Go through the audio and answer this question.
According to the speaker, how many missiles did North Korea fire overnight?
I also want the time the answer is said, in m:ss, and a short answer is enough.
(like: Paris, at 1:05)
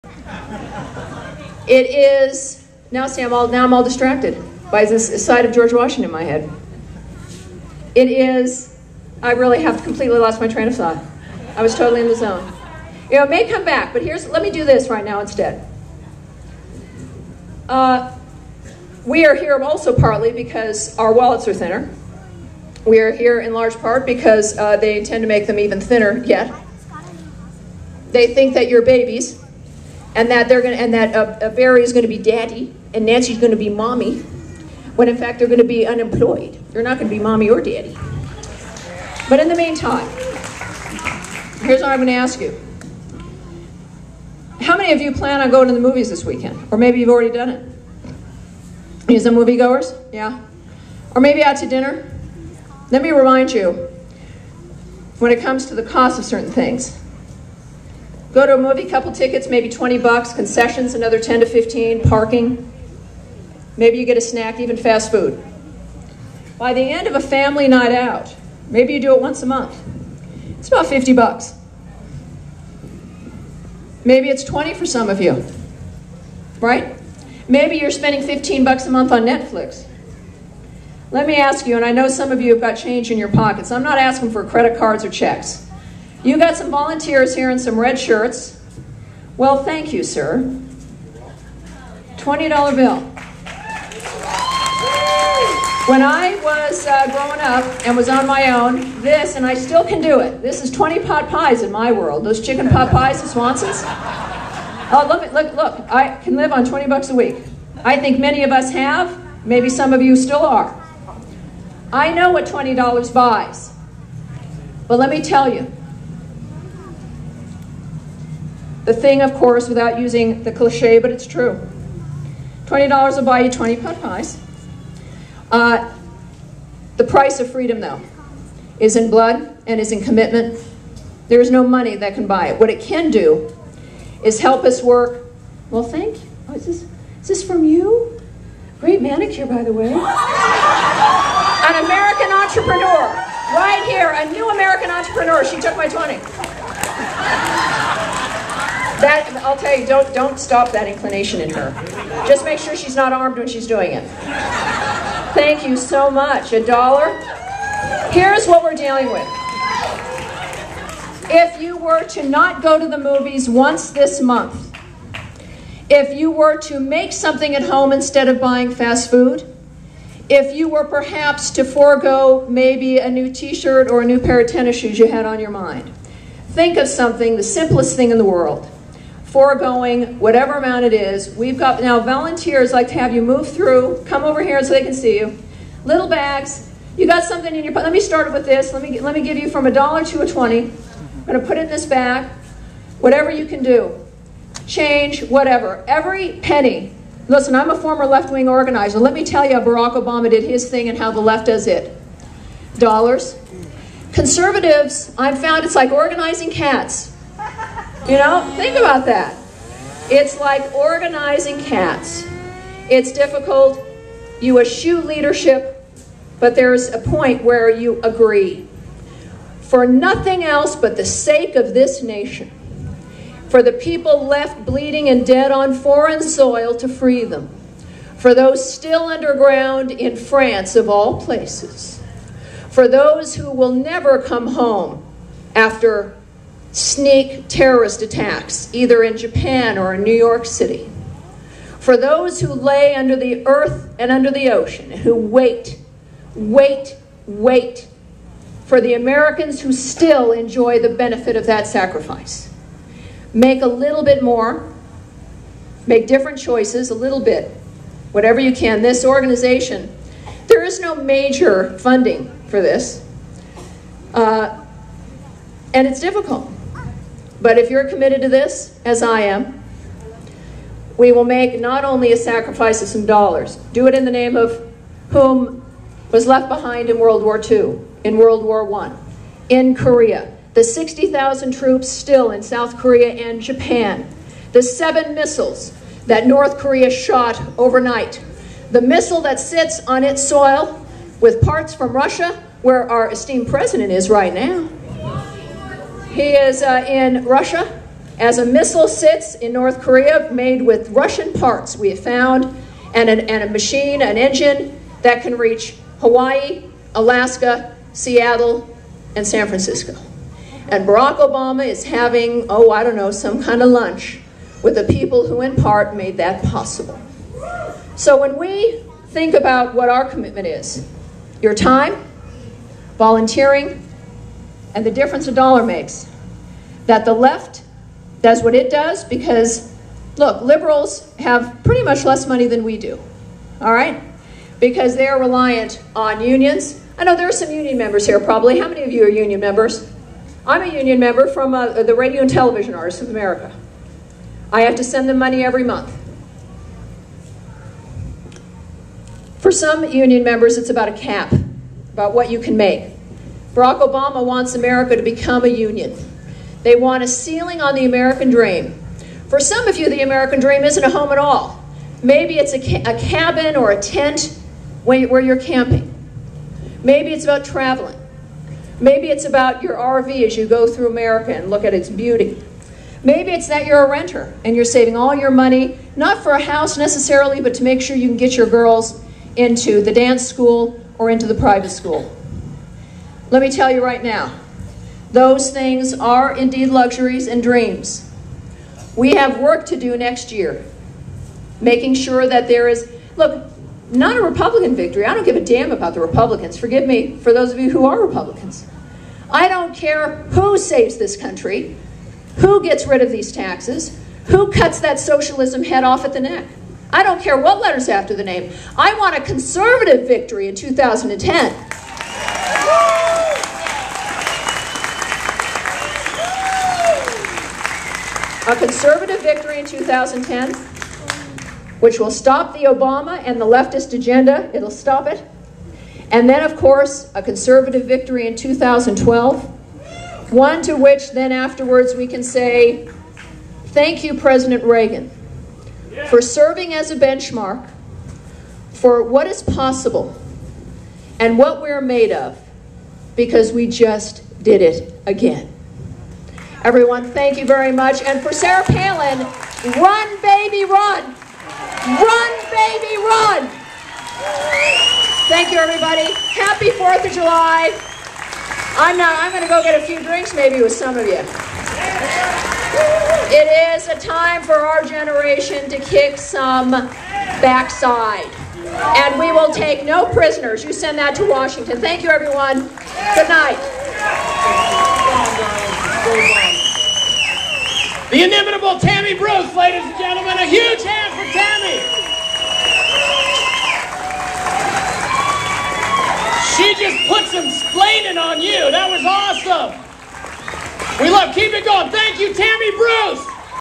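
7, at 4:44.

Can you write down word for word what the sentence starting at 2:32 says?
Just make sure she's not armed when she's doing it.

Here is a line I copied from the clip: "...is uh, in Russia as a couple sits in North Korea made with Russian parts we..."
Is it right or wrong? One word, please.
wrong.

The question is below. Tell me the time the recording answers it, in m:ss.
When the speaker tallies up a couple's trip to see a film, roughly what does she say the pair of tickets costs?
0:59.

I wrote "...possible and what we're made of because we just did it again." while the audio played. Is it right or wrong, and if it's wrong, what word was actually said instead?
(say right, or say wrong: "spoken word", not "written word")
right.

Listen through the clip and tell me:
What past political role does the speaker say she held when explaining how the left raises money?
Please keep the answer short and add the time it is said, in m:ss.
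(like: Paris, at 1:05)
former left wing organizer, at 3:17.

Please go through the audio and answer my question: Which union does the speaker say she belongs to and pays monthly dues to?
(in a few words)
Radio and Television Artists of America.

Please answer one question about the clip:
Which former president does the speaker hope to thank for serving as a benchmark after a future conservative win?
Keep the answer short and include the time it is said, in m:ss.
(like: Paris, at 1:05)
Reagan, at 7:14.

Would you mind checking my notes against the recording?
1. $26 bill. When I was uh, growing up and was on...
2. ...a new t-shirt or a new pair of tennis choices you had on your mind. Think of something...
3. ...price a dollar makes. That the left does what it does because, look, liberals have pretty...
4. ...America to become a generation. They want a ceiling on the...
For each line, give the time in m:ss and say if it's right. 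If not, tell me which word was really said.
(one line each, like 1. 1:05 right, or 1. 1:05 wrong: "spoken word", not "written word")
1. 1:32 wrong: "20", not "26"
2. 2:52 wrong: "shoes", not "choices"
3. 5:24 wrong: "difference", not "price"
4. 5:54 wrong: "union", not "generation".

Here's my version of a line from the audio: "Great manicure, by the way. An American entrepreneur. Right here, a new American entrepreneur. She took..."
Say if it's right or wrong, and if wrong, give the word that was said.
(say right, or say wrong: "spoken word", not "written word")
right.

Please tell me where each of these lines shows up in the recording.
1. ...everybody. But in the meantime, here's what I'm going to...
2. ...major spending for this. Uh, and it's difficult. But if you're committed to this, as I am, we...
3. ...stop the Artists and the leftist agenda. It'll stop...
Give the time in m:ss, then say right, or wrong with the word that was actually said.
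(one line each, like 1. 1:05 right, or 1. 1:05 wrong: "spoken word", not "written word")
1. 0:37 wrong: "daddy", not "everybody"
2. 4:20 wrong: "funding", not "spending"
3. 7:02 wrong: "Obama", not "Artists".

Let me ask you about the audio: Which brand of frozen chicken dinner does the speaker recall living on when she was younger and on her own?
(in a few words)
Swanson's.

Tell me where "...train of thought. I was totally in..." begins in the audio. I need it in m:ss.
0:10.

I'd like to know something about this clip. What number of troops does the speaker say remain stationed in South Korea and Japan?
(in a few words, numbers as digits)
60,000.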